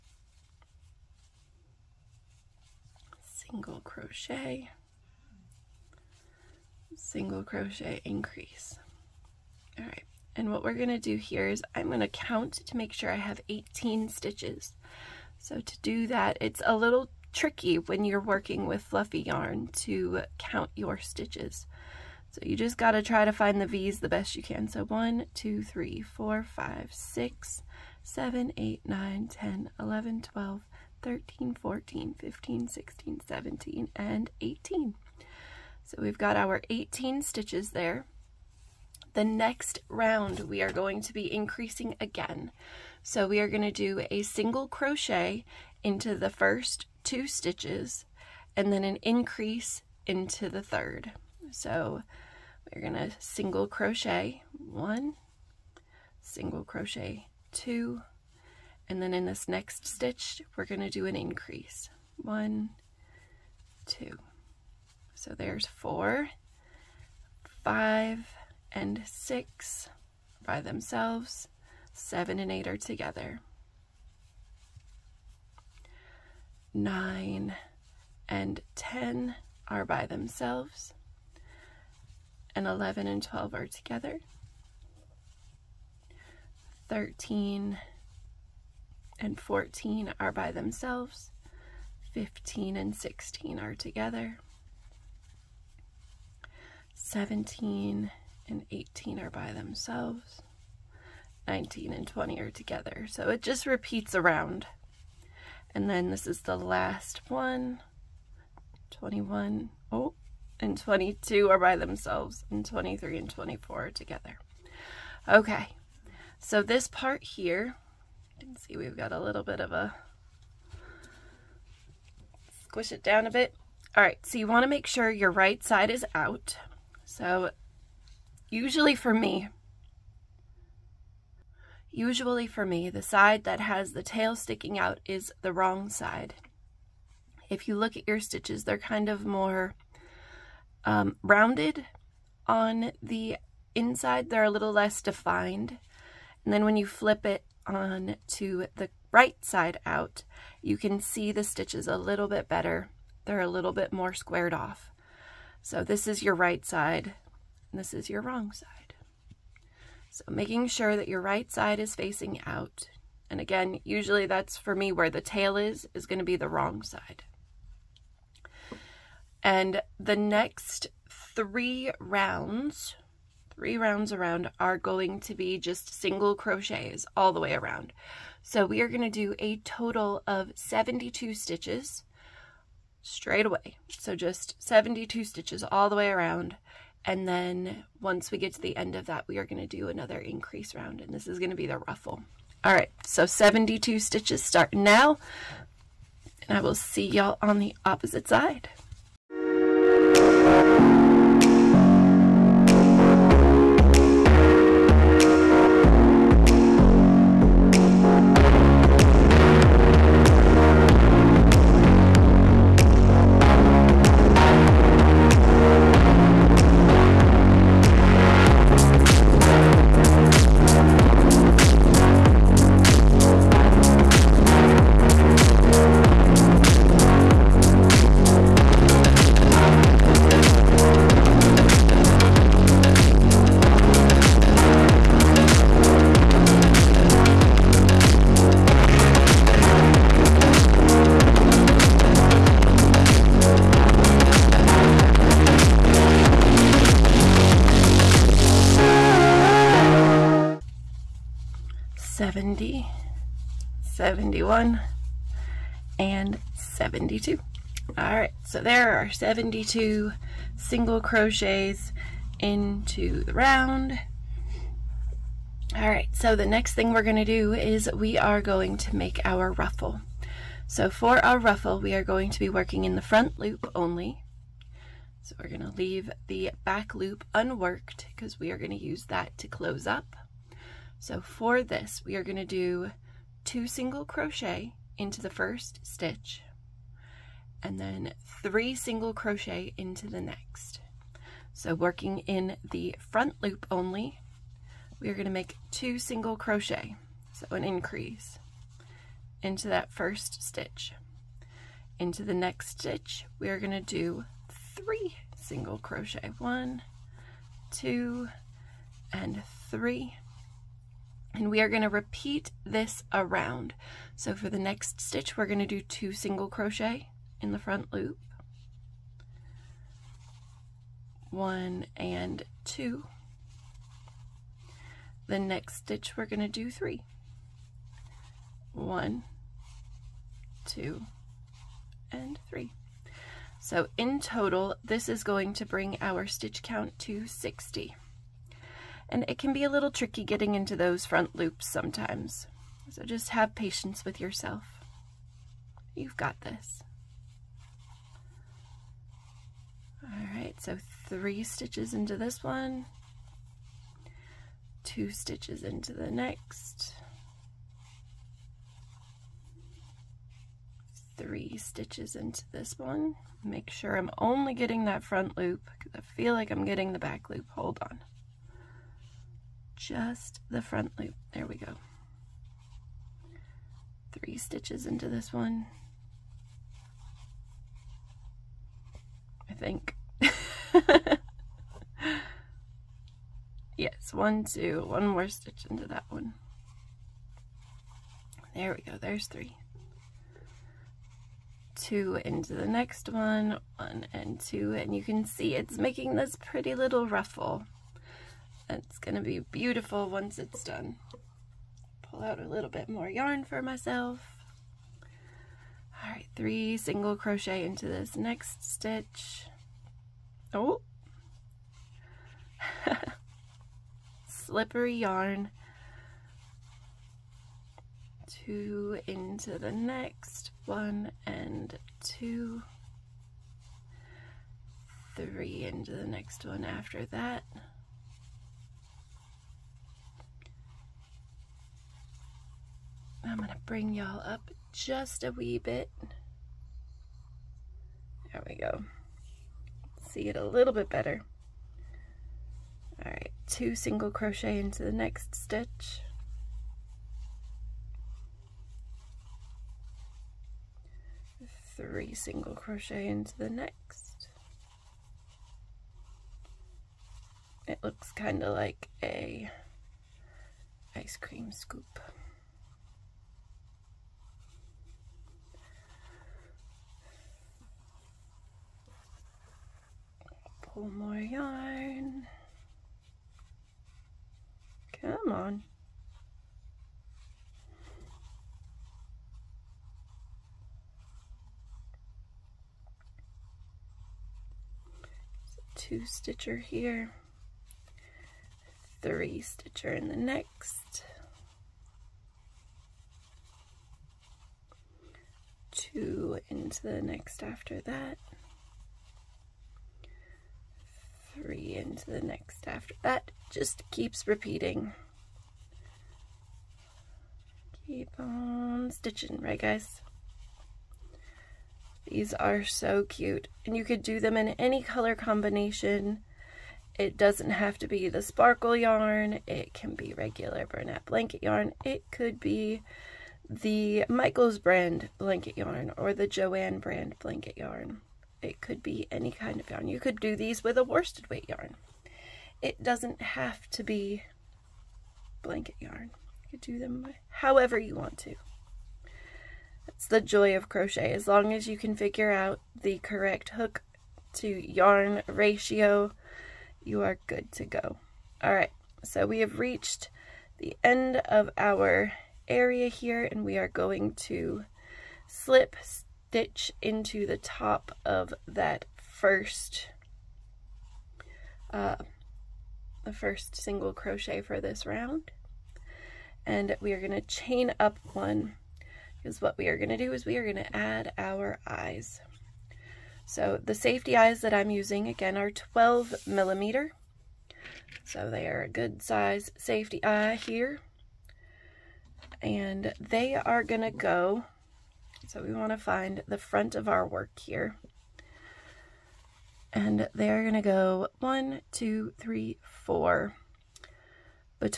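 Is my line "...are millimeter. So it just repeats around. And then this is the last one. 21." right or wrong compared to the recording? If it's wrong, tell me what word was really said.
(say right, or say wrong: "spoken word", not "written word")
wrong: "together", not "millimeter".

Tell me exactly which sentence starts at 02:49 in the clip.
And the next three rounds, three rounds around are going to be just single crochets all the way around.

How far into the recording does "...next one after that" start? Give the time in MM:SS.
07:06.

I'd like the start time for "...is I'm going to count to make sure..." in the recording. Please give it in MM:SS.
00:11.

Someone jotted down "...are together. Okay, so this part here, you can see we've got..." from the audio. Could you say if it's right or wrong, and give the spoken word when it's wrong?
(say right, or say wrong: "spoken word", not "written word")
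right.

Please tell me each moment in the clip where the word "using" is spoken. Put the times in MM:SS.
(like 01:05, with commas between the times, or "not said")
09:34.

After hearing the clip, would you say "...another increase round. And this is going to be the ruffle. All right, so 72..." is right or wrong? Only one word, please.
right.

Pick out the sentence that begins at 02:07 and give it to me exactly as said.
So usually for me, usually for me, the side that has the tail sticking out is the wrong side.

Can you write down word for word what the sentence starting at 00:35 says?
So we've got our 18 stitches there.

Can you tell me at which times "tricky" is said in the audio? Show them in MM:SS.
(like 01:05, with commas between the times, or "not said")
00:17, 05:39.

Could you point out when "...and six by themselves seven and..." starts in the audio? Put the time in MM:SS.
01:08.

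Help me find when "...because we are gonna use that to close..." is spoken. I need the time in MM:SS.
04:38.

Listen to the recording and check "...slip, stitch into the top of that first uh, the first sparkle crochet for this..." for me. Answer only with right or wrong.
wrong.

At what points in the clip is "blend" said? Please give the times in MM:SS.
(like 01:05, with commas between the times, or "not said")
not said.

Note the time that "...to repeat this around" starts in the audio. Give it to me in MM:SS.
05:11.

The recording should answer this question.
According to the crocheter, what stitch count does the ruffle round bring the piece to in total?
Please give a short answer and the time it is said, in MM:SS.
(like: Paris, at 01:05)
60, at 05:37.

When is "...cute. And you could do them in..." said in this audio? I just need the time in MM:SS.
08:33.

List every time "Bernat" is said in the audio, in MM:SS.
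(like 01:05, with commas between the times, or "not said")
08:40.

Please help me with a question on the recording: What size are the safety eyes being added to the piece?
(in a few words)
12 millimeter.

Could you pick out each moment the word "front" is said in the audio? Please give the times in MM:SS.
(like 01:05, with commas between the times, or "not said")
04:33, 04:52, 05:17, 05:41, 06:05, 06:10, 09:46.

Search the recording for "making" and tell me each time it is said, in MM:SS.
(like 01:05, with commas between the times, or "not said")
02:40, 06:35.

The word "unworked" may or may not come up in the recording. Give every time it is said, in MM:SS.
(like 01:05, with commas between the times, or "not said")
04:37.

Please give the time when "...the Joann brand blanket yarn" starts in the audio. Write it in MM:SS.
08:46.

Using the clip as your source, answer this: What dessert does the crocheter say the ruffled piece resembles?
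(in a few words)
ice cream scoop.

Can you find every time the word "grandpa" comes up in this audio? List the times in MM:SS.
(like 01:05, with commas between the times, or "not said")
not said.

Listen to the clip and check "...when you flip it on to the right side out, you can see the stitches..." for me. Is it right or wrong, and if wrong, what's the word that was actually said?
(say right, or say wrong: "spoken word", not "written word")
right.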